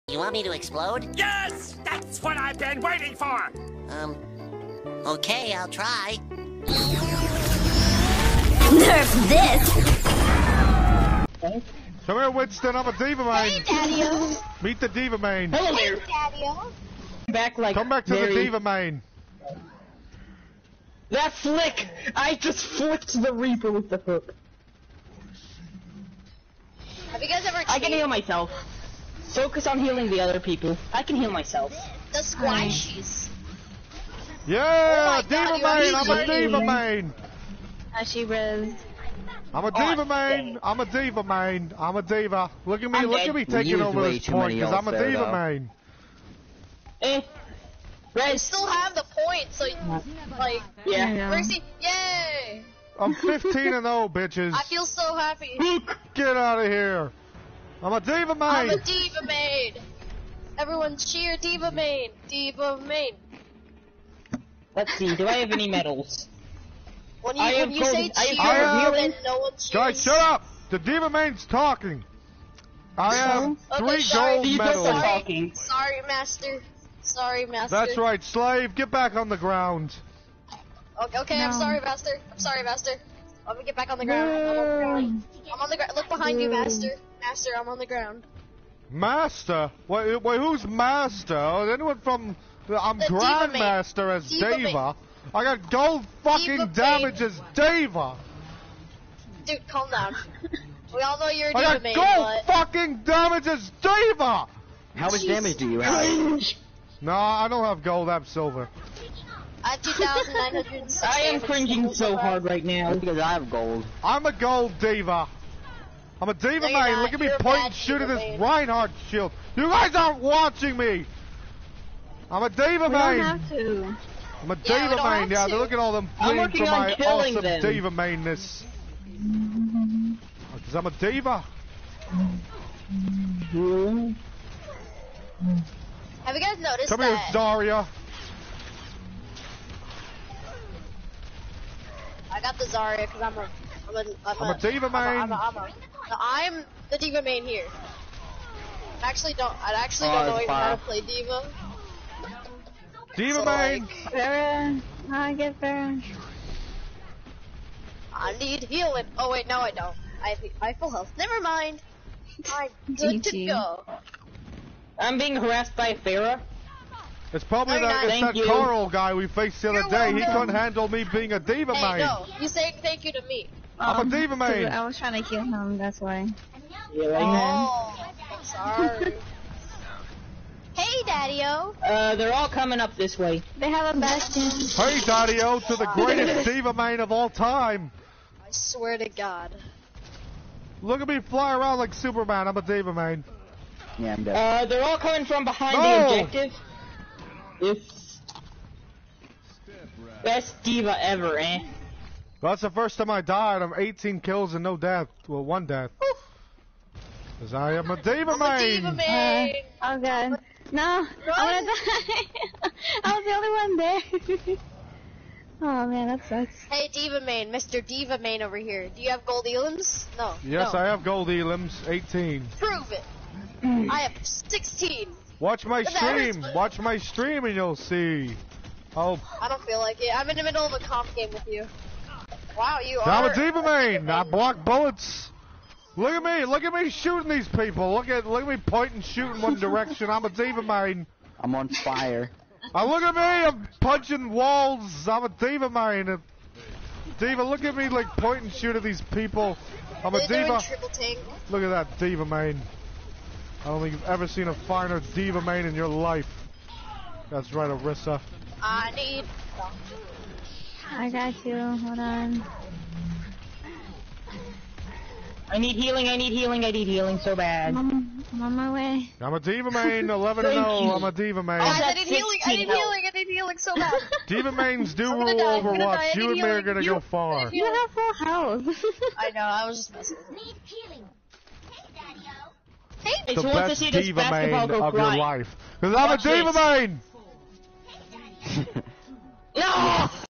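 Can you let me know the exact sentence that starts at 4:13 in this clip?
I don't think you've ever seen a finer D.Va main in your life.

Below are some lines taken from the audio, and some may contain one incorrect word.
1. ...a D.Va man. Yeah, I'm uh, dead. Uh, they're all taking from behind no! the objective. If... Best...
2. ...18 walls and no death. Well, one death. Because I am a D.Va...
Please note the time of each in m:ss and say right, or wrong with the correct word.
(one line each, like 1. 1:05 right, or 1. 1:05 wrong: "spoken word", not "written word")
1. 3:12 wrong: "coming", not "taking"
2. 3:23 wrong: "kills", not "walls".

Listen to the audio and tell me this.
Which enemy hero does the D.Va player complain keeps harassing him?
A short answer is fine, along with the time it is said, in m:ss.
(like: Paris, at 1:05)
Pharah, at 2:45.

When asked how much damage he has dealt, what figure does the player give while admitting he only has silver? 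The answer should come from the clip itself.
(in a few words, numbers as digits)
2,900.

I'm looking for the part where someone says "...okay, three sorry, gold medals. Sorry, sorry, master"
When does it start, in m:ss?
1:13.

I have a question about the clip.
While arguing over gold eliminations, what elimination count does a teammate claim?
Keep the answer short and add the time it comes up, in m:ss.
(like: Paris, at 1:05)
16, at 3:44.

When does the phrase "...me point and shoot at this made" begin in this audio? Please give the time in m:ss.
1:57.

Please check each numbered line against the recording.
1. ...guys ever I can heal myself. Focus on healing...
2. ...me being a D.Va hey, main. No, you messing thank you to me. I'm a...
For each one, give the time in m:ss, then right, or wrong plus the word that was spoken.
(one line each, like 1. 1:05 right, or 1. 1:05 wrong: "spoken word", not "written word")
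1. 0:27 right
2. 2:50 wrong: "saying", not "messing".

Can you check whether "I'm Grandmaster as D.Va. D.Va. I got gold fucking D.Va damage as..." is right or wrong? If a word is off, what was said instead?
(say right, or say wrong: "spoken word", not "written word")
right.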